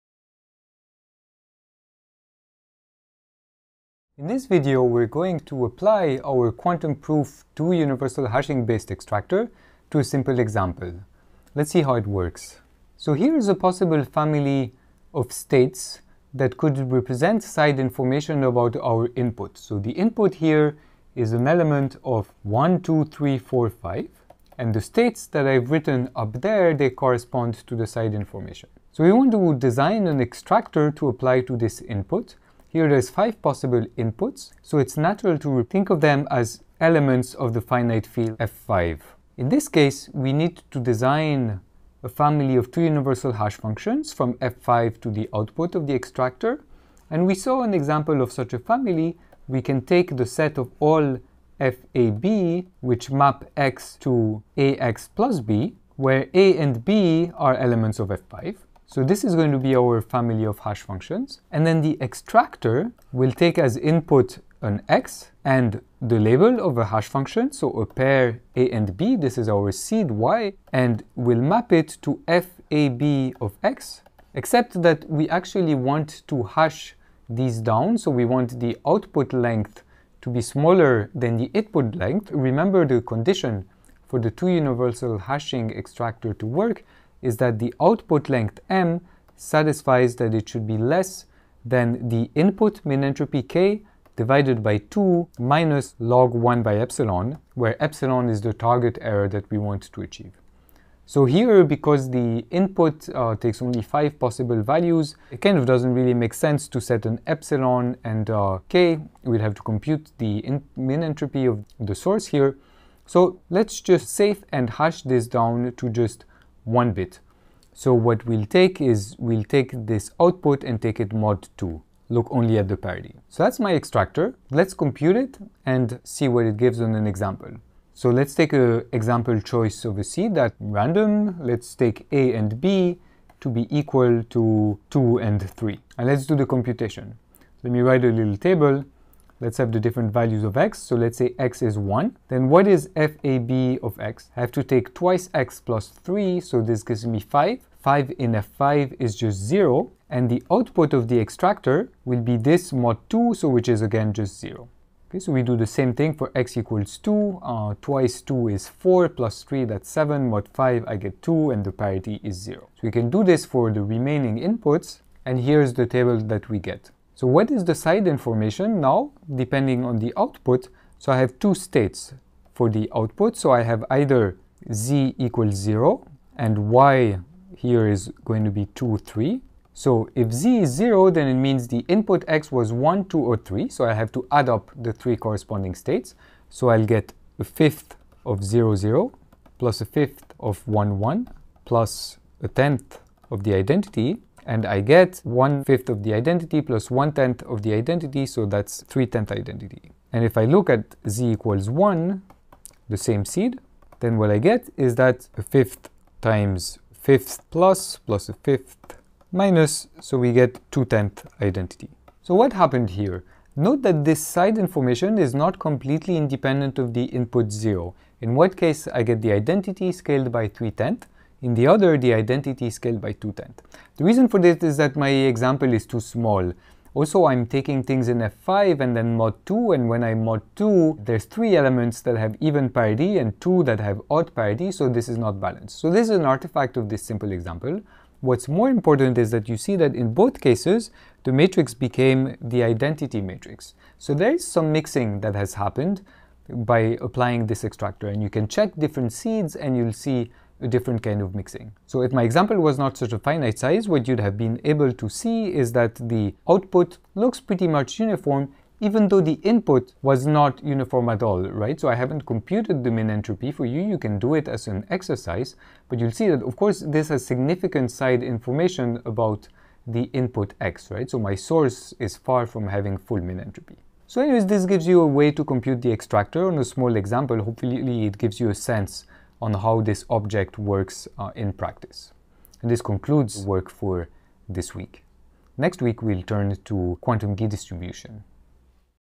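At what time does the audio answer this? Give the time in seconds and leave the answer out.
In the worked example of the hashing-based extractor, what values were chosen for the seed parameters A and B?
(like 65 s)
134 s.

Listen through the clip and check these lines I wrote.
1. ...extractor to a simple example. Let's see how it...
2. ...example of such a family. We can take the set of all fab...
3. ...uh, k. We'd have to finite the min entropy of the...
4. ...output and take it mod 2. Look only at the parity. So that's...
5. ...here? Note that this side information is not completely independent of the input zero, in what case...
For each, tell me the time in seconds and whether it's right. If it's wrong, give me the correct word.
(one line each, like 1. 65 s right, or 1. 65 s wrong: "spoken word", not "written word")
1. 8 s right
2. 47 s right
3. 108 s wrong: "compute", not "finite"
4. 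120 s right
5. 212 s right.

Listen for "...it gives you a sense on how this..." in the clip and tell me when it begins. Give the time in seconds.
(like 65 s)
278 s.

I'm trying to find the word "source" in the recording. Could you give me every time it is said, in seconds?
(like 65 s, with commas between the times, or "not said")
111 s, 271 s.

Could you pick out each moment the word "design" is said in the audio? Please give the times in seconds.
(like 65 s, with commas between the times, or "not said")
29 s, 40 s.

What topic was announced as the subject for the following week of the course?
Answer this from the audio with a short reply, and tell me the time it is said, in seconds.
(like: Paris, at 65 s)
quantum key distribution, at 287 s.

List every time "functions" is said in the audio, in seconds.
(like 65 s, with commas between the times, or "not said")
43 s, 60 s, 67 s.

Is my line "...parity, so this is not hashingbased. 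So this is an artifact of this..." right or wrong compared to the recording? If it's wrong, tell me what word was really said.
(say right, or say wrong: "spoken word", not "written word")
wrong: "balanced", not "hashingbased".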